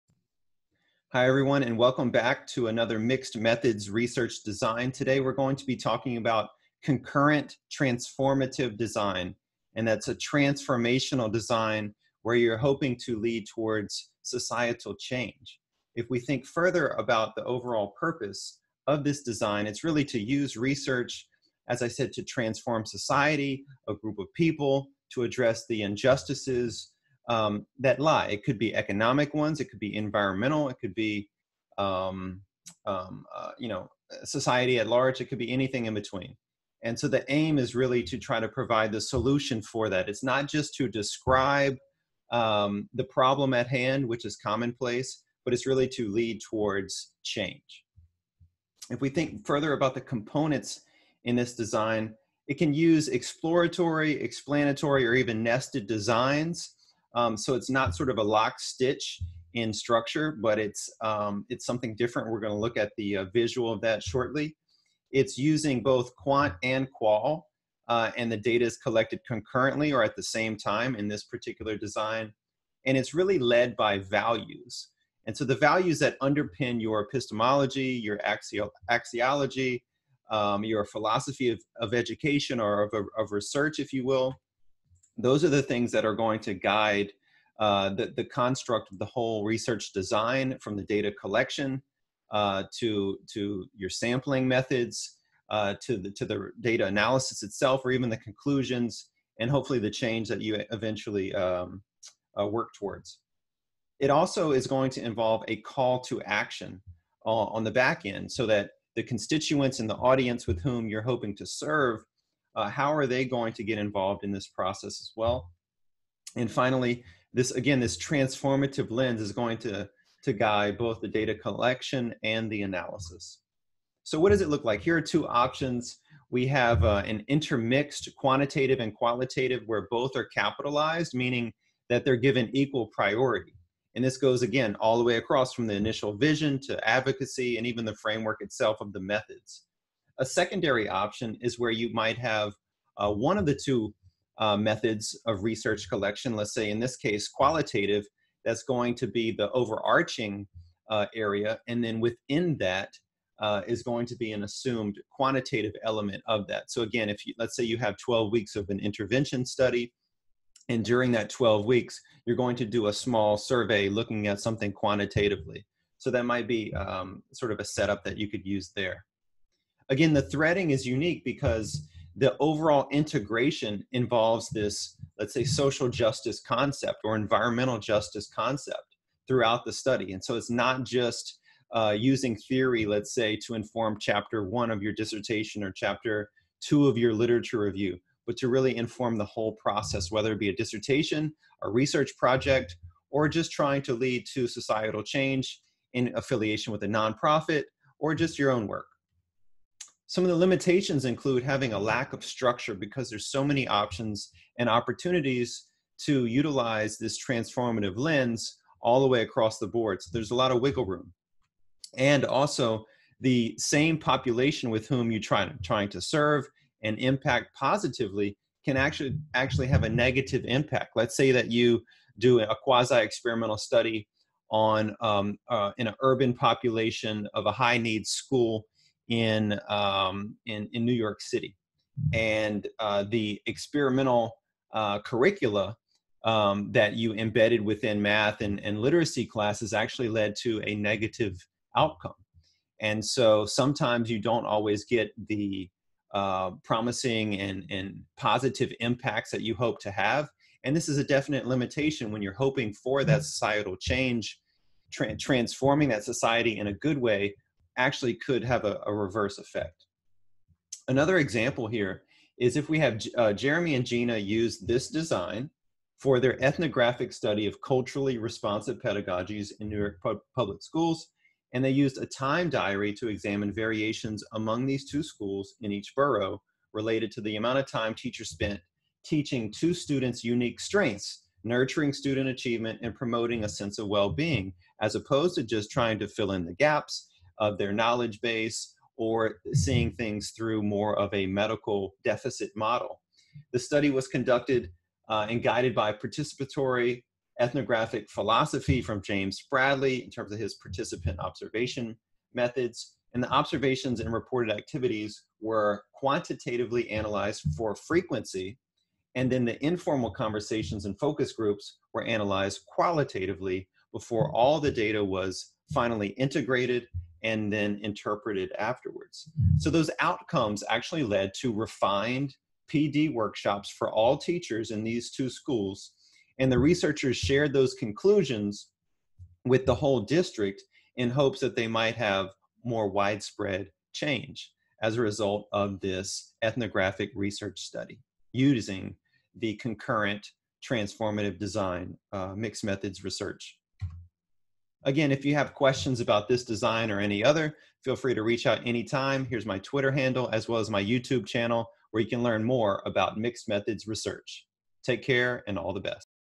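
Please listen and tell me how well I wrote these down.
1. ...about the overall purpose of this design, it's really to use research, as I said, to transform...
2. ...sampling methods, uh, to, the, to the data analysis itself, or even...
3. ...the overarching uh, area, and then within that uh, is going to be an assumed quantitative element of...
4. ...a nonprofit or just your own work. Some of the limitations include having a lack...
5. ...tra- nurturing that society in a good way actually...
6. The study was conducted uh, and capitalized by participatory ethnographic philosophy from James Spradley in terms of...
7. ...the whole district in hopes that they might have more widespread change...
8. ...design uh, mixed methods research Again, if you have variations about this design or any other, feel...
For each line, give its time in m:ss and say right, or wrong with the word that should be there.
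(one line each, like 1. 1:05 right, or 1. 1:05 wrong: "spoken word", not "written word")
1. 0:16 right
2. 1:33 right
3. 2:29 right
4. 3:16 right
5. 4:14 wrong: "transforming", not "nurturing"
6. 4:53 wrong: "guided", not "capitalized"
7. 5:29 right
8. 5:41 wrong: "questions", not "variations".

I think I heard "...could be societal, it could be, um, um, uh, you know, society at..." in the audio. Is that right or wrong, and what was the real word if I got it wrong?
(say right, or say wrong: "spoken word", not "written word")
wrong: "environmental", not "societal".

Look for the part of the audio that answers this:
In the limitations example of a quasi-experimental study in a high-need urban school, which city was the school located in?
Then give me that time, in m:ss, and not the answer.
3:50.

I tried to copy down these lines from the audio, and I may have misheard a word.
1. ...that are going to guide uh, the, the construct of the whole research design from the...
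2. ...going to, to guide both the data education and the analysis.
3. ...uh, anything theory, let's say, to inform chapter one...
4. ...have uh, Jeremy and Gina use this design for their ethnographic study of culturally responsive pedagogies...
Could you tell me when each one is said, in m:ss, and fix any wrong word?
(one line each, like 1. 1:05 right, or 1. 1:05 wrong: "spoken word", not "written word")
1. 1:25 right
2. 1:59 wrong: "collection", not "education"
3. 3:01 wrong: "using", not "anything"
4. 4:22 right.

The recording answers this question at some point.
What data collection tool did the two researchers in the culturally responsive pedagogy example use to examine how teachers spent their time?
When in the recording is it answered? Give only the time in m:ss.
4:32.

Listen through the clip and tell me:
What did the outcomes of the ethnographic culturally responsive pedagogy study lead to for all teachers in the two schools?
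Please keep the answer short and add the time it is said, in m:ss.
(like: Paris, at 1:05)
Refined PD workshops, at 5:21.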